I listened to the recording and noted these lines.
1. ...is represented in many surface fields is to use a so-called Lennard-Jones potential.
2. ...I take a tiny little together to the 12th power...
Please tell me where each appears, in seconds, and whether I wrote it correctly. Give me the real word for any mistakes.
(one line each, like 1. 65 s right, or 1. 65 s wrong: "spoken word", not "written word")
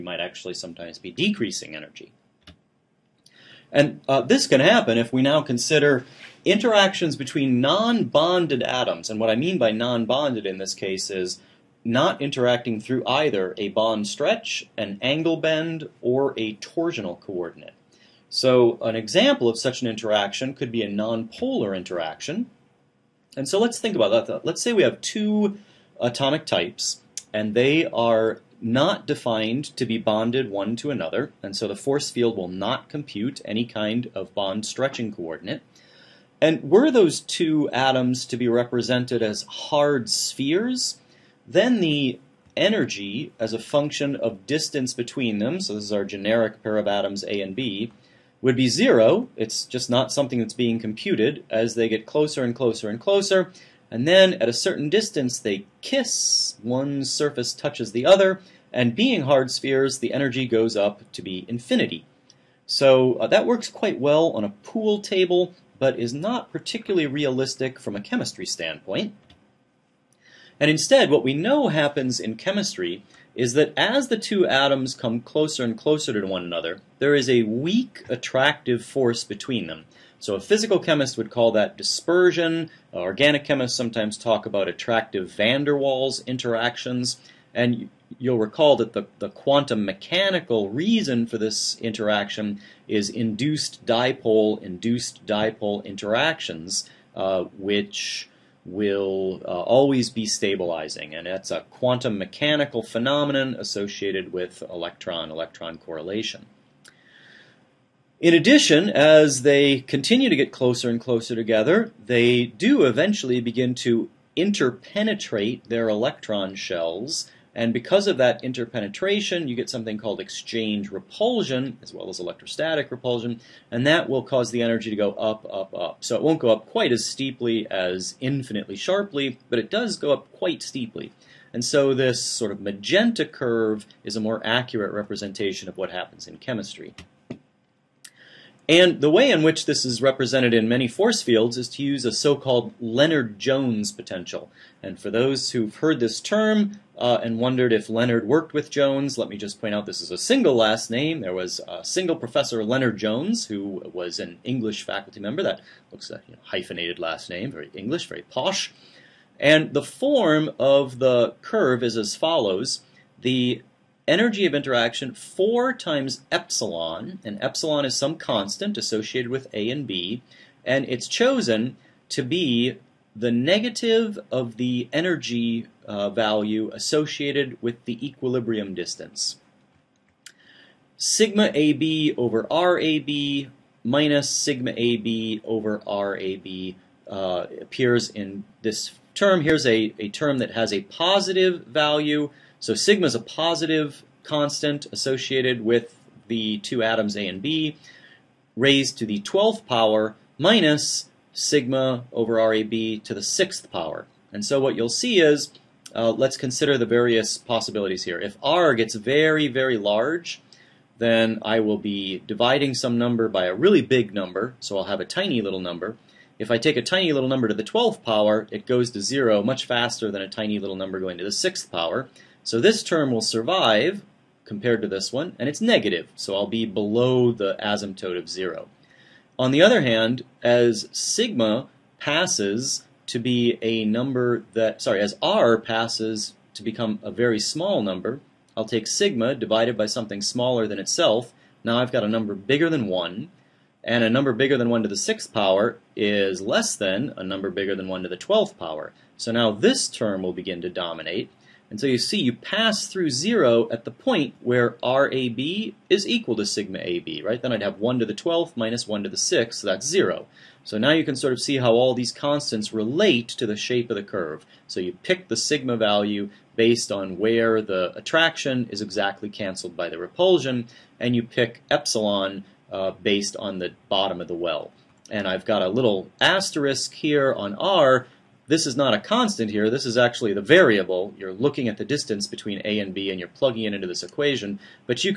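1. 139 s wrong: "force", not "surface"
2. 216 s wrong: "number", not "together".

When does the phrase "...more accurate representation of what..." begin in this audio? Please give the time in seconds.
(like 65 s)
134 s.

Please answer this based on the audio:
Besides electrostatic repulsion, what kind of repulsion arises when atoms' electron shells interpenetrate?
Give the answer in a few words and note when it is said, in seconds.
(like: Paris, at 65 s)
exchange repulsion, at 120 s.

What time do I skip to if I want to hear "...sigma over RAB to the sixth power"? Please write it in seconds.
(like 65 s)
201 s.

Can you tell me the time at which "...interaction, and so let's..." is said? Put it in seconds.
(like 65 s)
21 s.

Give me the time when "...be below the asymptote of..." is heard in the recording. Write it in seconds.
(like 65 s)
226 s.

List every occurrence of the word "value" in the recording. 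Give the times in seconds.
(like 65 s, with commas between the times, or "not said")
176 s, 191 s, 265 s.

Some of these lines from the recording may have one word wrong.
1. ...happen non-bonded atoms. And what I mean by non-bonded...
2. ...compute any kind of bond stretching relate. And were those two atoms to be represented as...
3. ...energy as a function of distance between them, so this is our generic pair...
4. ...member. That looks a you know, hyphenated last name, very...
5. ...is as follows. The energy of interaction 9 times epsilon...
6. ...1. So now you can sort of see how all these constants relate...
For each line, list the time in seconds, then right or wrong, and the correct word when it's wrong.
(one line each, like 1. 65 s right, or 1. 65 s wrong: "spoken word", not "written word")
1. 7 s wrong: "between", not "happen"
2. 32 s wrong: "coordinate", not "relate"
3. 42 s right
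4. 155 s right
5. 161 s wrong: "4", not "9"
6. 259 s wrong: "0", not "1".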